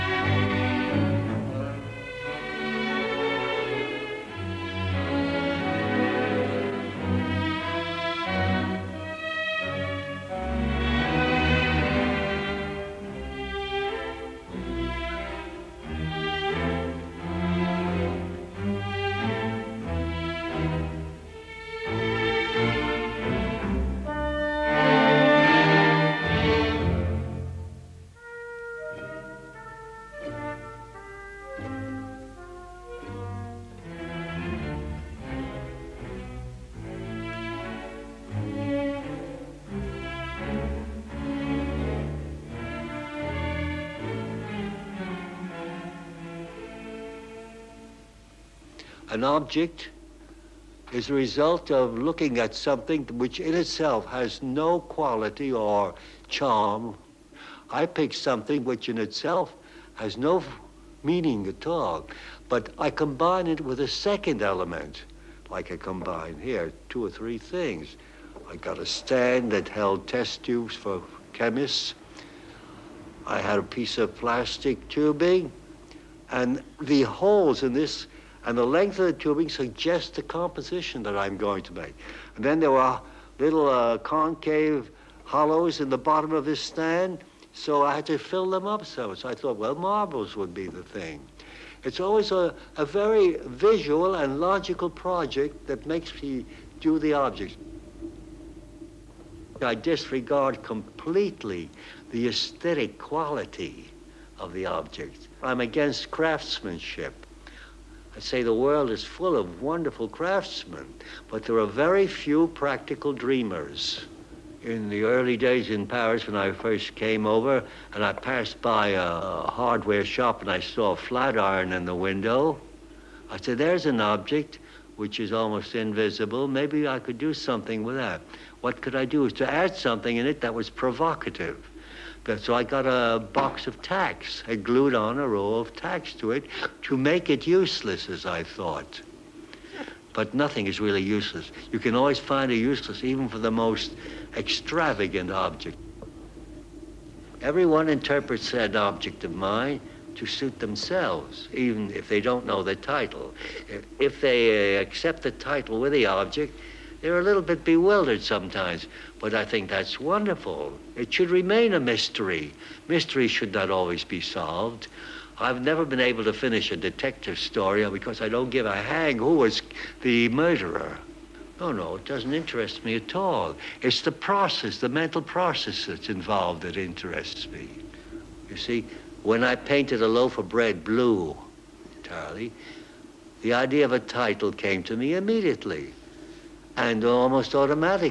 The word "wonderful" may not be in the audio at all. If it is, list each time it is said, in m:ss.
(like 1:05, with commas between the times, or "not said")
1:49, 2:39.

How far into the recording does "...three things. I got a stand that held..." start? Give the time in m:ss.
1:07.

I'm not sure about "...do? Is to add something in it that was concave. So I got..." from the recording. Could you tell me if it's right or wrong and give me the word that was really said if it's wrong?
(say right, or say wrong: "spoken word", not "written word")
wrong: "provocative", not "concave".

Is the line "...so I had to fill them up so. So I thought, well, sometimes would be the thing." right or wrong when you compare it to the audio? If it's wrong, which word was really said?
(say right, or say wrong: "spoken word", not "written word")
wrong: "marbles", not "sometimes".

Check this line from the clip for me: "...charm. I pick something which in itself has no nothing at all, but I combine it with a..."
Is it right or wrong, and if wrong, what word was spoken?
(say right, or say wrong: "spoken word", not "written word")
wrong: "meaning", not "nothing".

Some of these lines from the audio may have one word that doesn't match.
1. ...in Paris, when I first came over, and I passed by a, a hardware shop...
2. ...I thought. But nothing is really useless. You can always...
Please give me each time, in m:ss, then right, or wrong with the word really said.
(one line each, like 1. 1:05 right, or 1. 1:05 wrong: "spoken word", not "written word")
1. 1:55 right
2. 2:18 right.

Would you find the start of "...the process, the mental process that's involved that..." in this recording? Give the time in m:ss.
2:54.